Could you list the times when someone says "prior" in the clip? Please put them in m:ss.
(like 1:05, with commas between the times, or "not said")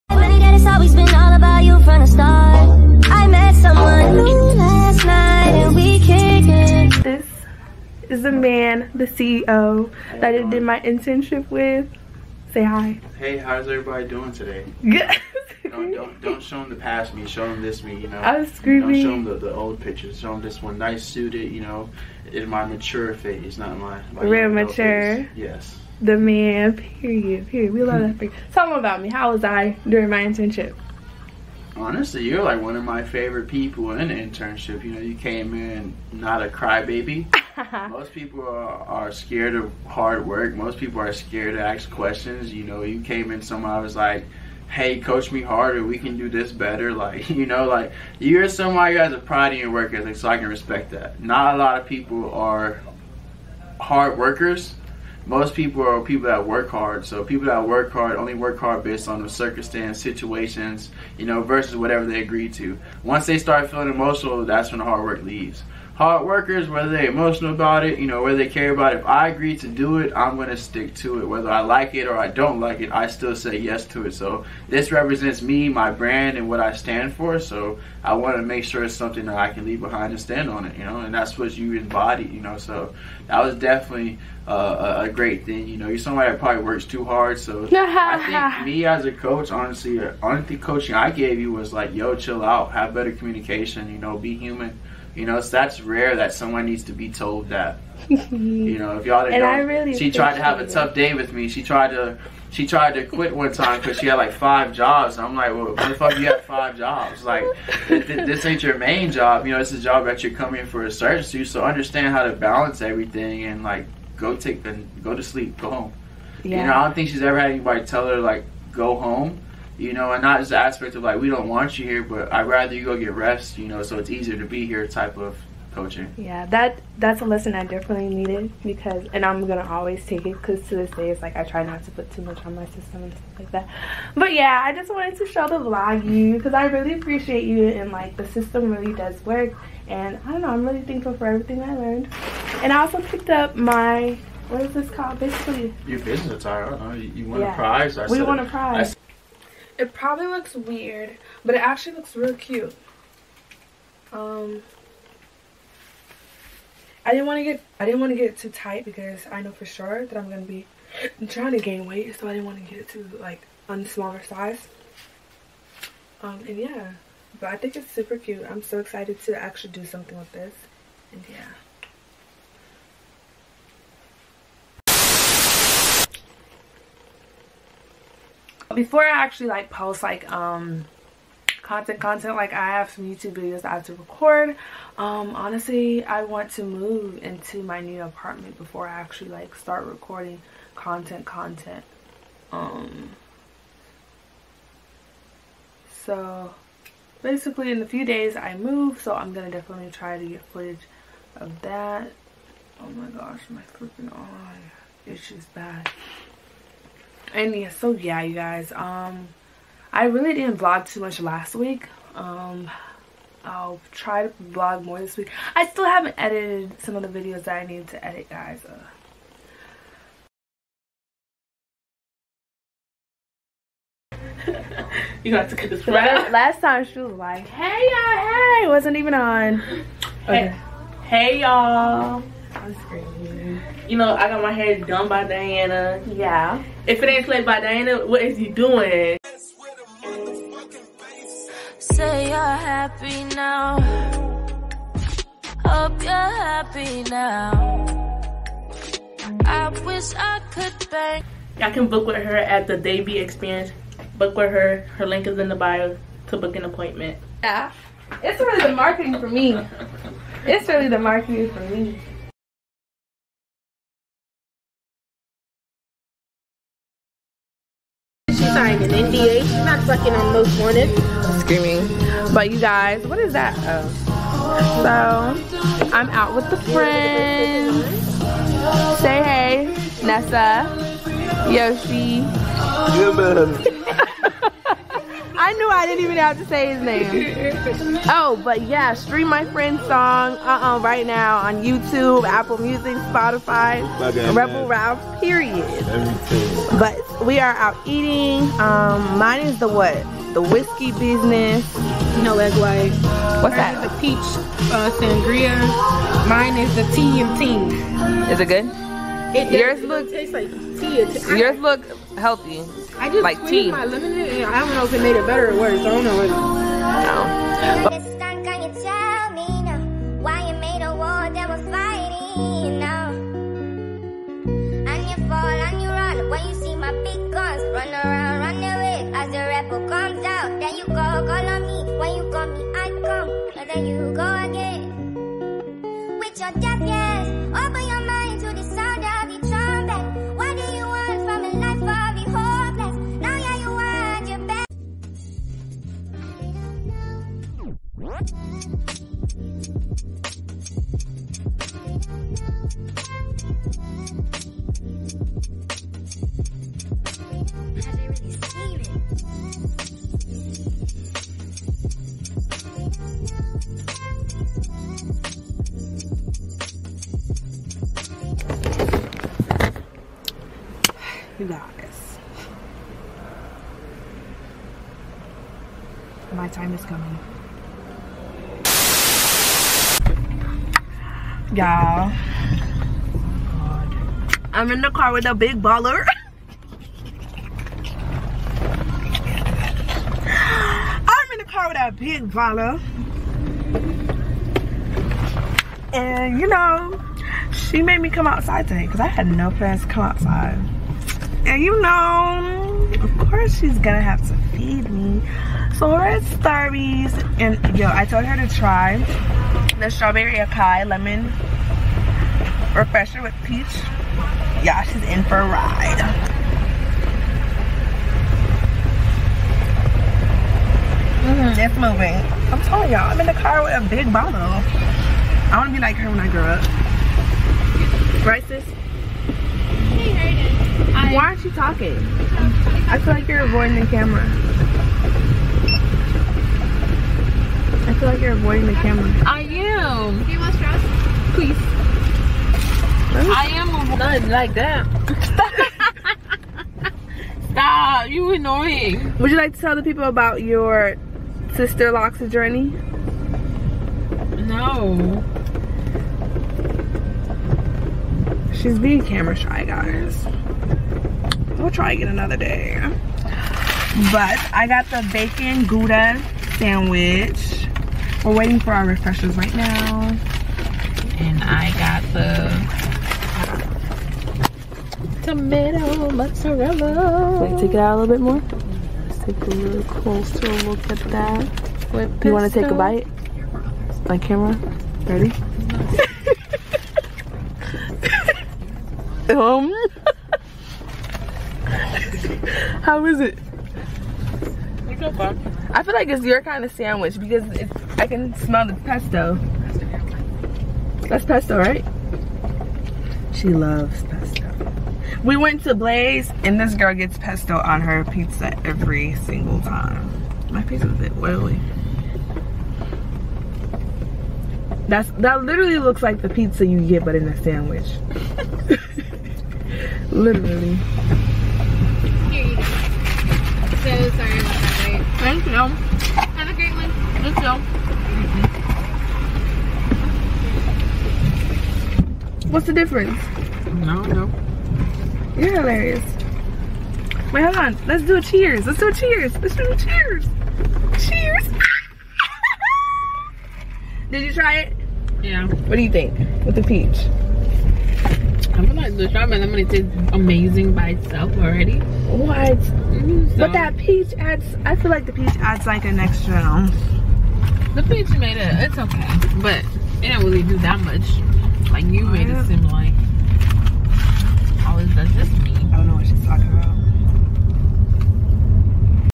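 not said.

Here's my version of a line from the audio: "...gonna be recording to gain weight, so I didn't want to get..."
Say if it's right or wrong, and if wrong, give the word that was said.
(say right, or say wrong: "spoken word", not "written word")
wrong: "trying", not "recording".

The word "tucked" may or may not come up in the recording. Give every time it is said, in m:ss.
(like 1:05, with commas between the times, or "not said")
not said.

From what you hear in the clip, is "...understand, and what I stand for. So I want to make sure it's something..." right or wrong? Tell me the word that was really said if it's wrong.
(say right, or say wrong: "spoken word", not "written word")
wrong: "brand", not "understand".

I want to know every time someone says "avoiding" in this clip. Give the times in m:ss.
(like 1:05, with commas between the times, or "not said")
7:13, 7:18.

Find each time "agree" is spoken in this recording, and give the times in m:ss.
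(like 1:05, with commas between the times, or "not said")
1:02, 1:09.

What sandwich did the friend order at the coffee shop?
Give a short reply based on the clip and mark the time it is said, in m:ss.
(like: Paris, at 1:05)
Tomato mozzarella, at 7:55.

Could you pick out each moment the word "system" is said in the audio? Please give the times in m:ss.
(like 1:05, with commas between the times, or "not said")
2:12, 2:18.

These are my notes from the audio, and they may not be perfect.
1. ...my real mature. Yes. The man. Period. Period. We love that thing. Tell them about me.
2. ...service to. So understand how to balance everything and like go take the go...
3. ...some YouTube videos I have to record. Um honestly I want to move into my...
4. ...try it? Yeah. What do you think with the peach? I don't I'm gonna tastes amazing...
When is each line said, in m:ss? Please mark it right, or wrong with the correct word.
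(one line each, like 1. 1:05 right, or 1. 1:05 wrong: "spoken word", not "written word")
1. 0:24 right
2. 1:50 right
3. 3:02 right
4. 9:04 right.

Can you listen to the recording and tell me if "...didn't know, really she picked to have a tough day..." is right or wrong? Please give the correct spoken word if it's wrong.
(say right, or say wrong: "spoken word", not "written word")
wrong: "tried", not "picked".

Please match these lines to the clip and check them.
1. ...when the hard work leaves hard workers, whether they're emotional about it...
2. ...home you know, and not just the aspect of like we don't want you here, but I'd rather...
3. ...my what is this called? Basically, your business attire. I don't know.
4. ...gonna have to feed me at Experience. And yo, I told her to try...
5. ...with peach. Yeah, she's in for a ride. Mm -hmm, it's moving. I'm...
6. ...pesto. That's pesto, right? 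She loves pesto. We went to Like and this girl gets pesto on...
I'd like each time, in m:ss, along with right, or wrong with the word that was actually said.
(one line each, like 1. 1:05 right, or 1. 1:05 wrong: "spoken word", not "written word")
1. 1:04 right
2. 1:58 right
3. 2:23 right
4. 6:43 wrong: "Starbies", not "Experience"
5. 6:53 right
6. 8:18 wrong: "Blaze", not "Like".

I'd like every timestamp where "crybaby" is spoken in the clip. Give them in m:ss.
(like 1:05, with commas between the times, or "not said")
0:36.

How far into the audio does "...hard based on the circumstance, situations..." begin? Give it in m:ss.
0:58.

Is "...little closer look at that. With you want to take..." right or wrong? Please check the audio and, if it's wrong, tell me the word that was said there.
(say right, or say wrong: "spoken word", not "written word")
right.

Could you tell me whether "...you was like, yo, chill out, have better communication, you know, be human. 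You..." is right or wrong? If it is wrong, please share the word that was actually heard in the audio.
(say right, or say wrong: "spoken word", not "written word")
right.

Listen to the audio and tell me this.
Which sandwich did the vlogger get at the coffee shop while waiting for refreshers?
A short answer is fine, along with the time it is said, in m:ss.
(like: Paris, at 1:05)
Bacon Gouda sandwich, at 7:45.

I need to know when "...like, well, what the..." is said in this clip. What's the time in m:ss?
1:45.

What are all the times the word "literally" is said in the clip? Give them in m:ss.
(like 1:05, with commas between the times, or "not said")
8:35, 8:40.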